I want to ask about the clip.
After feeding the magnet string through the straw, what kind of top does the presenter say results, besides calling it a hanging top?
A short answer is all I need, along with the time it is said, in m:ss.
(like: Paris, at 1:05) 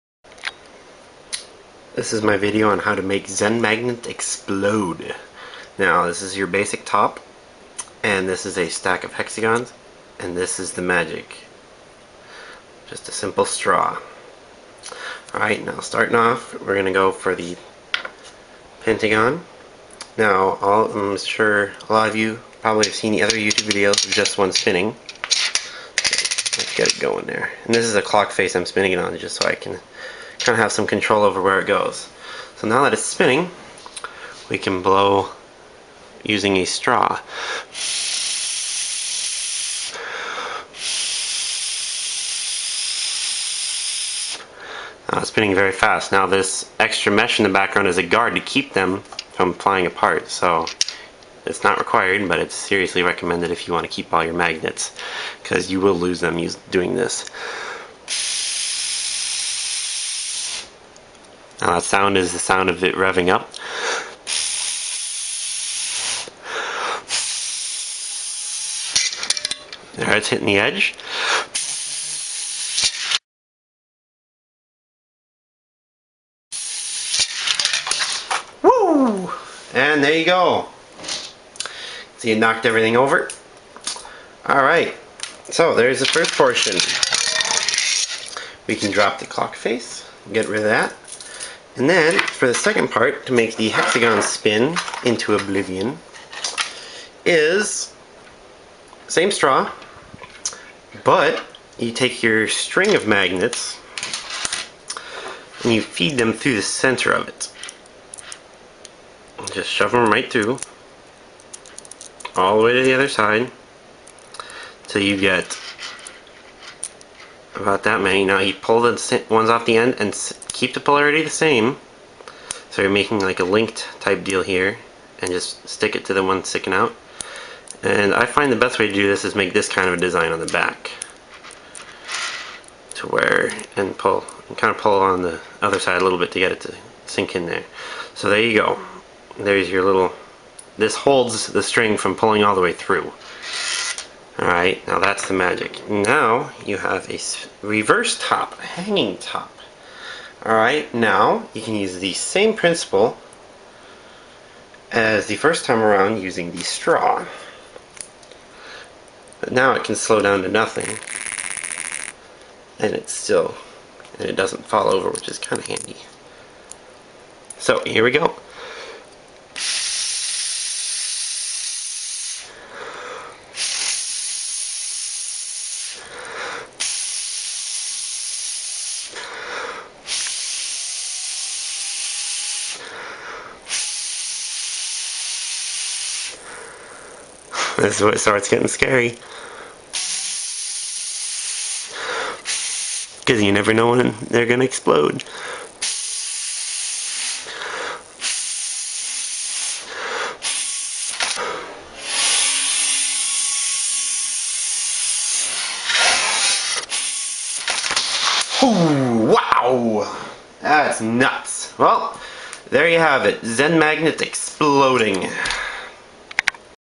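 A reverse top, at 2:27.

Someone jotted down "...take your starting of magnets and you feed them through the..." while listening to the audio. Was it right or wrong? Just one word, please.
wrong.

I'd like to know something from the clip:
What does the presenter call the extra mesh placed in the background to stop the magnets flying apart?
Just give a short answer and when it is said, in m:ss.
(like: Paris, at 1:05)
A guard, at 0:48.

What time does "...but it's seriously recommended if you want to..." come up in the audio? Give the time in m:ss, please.
0:52.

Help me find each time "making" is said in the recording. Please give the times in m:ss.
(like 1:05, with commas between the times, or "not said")
2:02.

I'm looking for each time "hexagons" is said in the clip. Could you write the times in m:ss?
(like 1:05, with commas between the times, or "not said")
0:09, 1:33.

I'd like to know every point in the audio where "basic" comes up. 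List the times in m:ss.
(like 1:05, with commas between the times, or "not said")
0:06.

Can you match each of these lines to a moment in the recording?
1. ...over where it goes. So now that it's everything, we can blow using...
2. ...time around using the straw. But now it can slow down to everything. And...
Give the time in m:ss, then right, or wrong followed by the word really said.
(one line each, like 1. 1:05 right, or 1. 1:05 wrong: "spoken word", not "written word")
1. 0:31 wrong: "spinning", not "everything"
2. 2:35 wrong: "nothing", not "everything".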